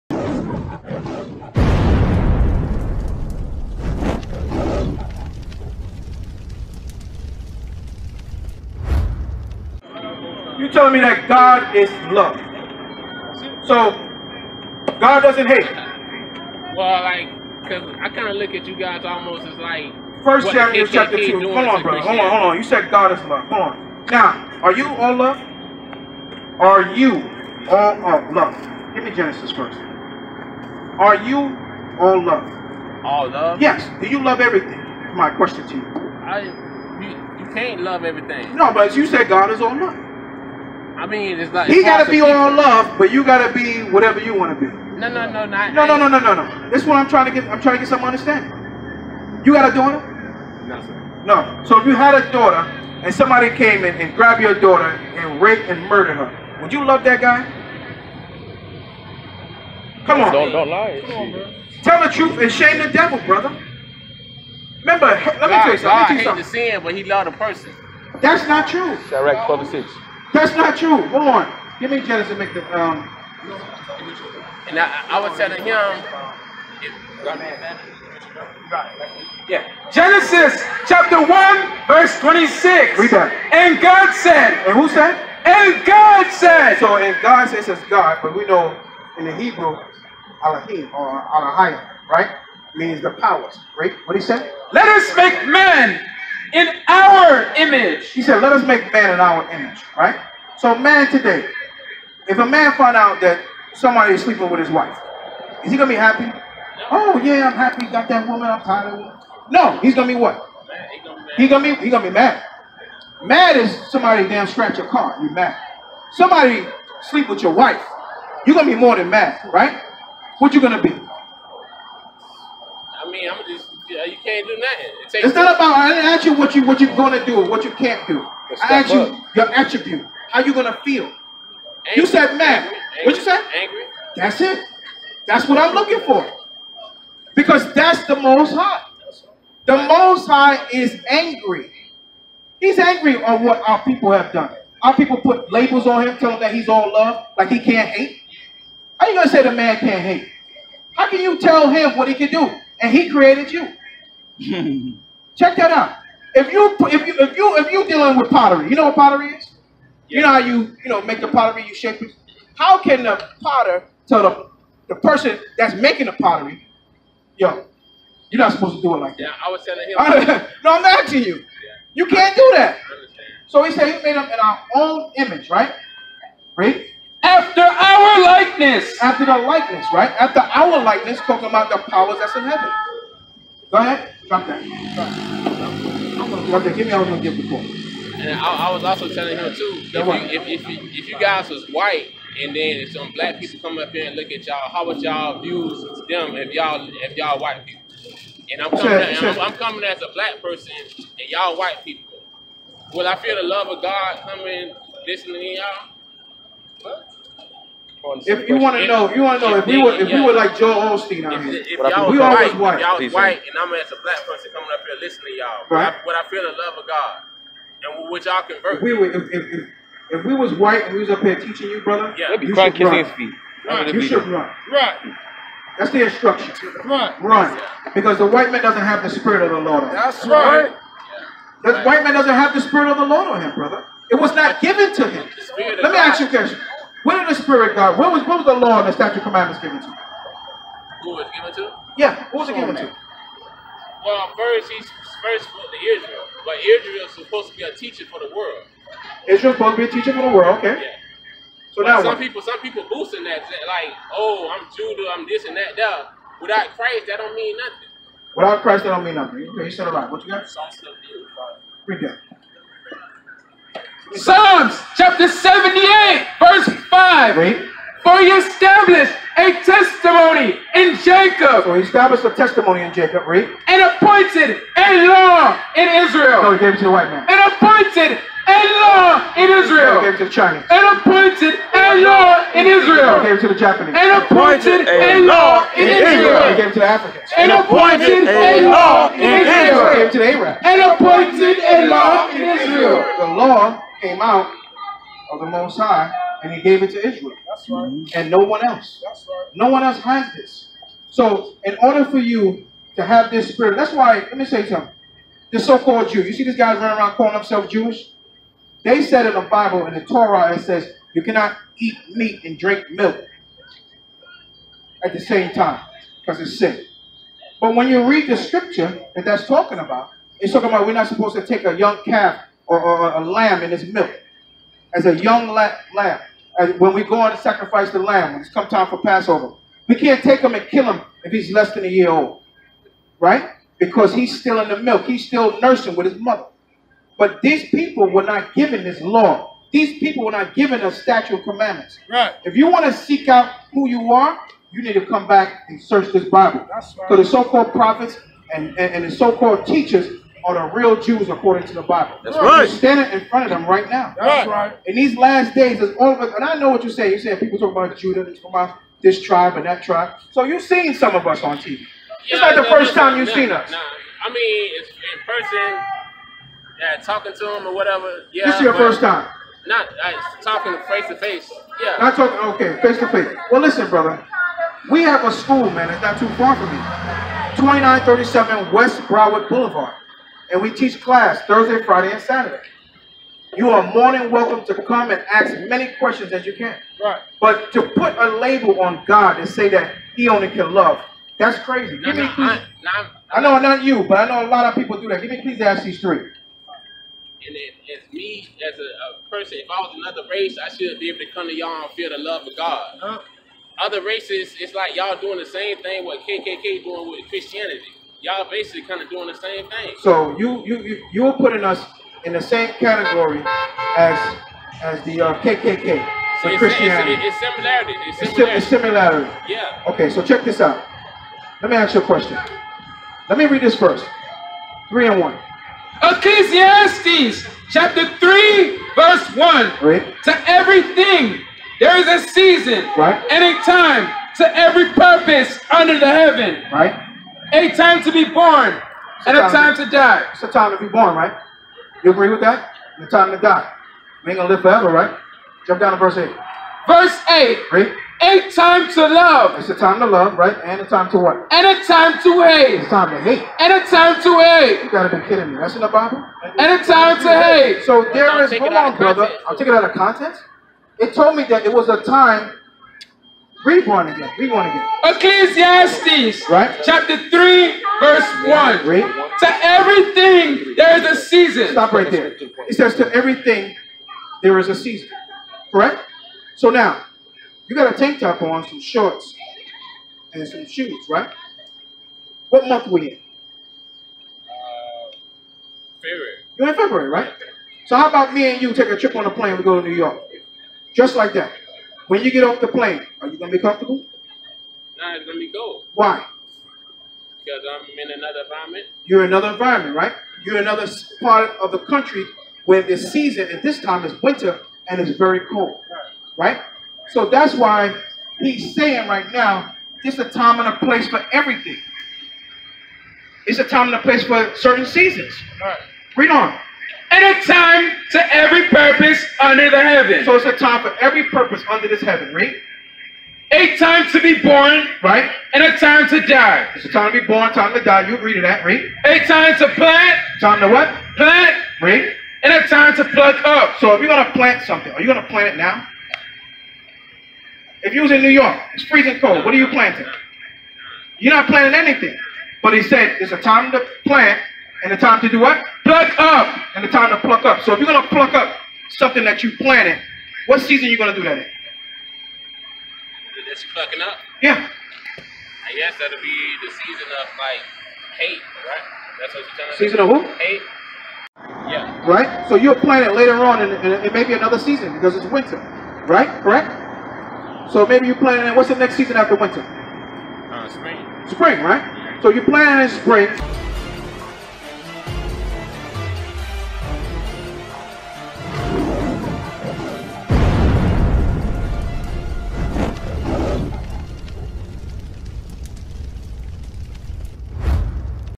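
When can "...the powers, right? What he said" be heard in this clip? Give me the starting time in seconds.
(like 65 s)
93 s.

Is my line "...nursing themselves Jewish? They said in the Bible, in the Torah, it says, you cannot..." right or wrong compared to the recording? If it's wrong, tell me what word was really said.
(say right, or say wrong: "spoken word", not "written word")
wrong: "calling", not "nursing".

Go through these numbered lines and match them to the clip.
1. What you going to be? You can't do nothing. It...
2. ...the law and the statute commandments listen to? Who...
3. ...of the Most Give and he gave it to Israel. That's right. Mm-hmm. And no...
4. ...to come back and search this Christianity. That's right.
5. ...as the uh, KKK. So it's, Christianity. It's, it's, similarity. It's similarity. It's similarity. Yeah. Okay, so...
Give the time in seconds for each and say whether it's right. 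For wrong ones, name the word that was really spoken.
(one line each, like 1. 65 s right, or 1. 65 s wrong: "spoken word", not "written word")
1. 120 s right
2. 238 s wrong: "given", not "listen"
3. 295 s wrong: "High", not "Give"
4. 344 s wrong: "Bible", not "Christianity"
5. 414 s right.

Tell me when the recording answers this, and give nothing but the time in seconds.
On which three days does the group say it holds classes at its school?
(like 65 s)
381 s.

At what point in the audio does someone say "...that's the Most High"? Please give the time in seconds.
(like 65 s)
137 s.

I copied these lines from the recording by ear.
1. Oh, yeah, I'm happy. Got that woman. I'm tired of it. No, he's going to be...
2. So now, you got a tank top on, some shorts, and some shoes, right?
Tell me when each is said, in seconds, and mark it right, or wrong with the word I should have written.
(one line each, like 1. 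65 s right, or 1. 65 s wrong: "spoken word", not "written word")
1. 106 s right
2. 476 s right.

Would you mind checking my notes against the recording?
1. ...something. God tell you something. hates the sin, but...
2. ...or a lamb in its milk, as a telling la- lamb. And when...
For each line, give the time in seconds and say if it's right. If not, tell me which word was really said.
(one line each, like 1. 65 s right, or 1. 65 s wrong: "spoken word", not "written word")
1. 65 s right
2. 323 s wrong: "young", not "telling".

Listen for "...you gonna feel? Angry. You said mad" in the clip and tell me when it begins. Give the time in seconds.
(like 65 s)
130 s.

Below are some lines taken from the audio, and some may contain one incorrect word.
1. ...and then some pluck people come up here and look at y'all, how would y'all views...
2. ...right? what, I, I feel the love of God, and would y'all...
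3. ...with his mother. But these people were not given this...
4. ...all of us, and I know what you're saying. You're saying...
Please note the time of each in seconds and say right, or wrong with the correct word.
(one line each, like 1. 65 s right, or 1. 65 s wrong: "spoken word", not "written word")
1. 192 s wrong: "black", not "pluck"
2. 215 s right
3. 335 s right
4. 355 s right.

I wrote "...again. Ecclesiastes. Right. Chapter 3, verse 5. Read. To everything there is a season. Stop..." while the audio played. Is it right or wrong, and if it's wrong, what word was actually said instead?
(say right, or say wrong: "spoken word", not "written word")
wrong: "1", not "5".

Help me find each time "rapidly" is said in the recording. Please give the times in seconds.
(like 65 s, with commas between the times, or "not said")
not said.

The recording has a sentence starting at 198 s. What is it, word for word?
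And I'm coming, sure, at, sure.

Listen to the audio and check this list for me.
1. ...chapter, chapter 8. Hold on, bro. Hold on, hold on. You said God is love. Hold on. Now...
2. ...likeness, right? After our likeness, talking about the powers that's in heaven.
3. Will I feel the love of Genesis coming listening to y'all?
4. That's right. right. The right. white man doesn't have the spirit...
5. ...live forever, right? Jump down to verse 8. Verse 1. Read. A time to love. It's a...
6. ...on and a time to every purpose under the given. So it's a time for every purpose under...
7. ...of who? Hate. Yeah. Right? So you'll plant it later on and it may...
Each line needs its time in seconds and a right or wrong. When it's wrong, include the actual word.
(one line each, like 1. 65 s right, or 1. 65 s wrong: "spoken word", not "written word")
1. 20 s wrong: "2", not "8"
2. 179 s right
3. 202 s wrong: "God", not "Genesis"
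4. 229 s right
5. 444 s wrong: "8", not "1"
6. 516 s wrong: "heaven", not "given"
7. 560 s right.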